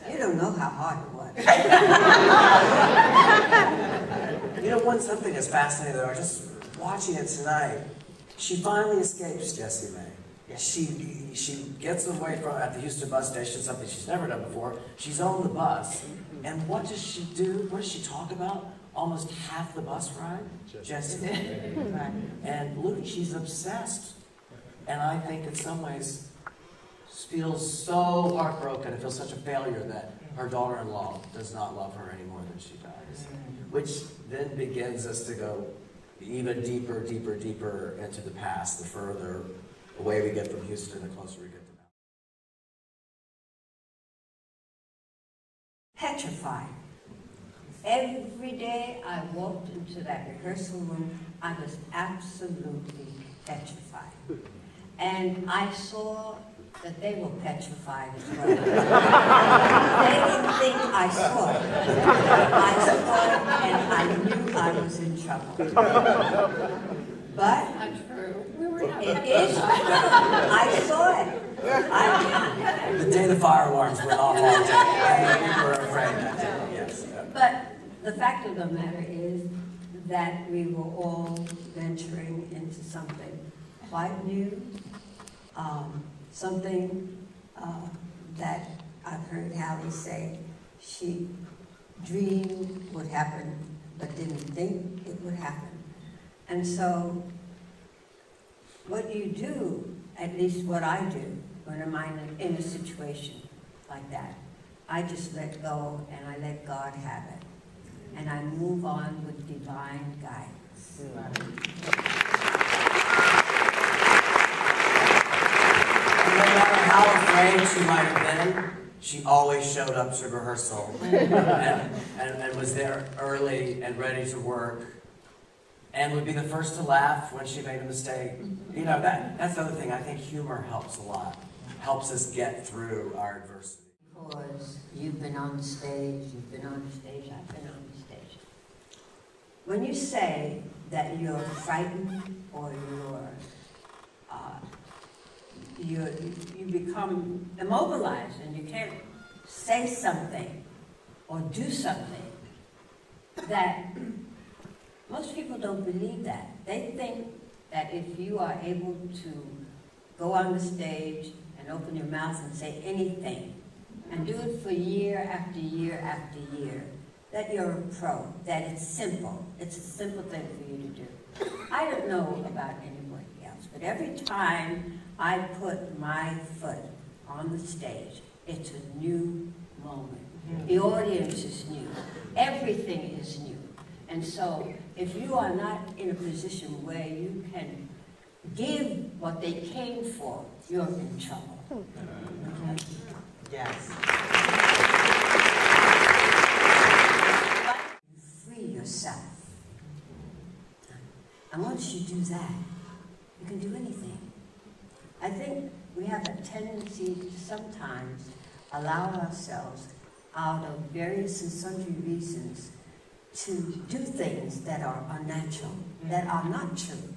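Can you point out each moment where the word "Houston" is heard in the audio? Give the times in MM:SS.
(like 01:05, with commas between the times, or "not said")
00:12, 00:40.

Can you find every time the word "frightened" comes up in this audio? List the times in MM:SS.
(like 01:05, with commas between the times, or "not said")
02:21.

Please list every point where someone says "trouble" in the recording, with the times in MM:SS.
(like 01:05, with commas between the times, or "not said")
01:05, 03:11.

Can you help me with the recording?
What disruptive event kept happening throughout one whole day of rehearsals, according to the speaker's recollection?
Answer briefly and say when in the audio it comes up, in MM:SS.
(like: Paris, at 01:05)
fire alarms, at 01:13.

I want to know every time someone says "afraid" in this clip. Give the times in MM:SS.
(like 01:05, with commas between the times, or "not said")
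01:15, 01:57.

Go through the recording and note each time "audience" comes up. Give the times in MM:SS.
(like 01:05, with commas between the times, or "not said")
03:00.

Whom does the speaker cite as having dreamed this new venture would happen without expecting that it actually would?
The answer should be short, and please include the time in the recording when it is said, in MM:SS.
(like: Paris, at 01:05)
Hallie, at 01:29.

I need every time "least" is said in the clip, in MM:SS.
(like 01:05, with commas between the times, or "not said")
01:40.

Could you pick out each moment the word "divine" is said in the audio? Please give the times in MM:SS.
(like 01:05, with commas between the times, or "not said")
01:49.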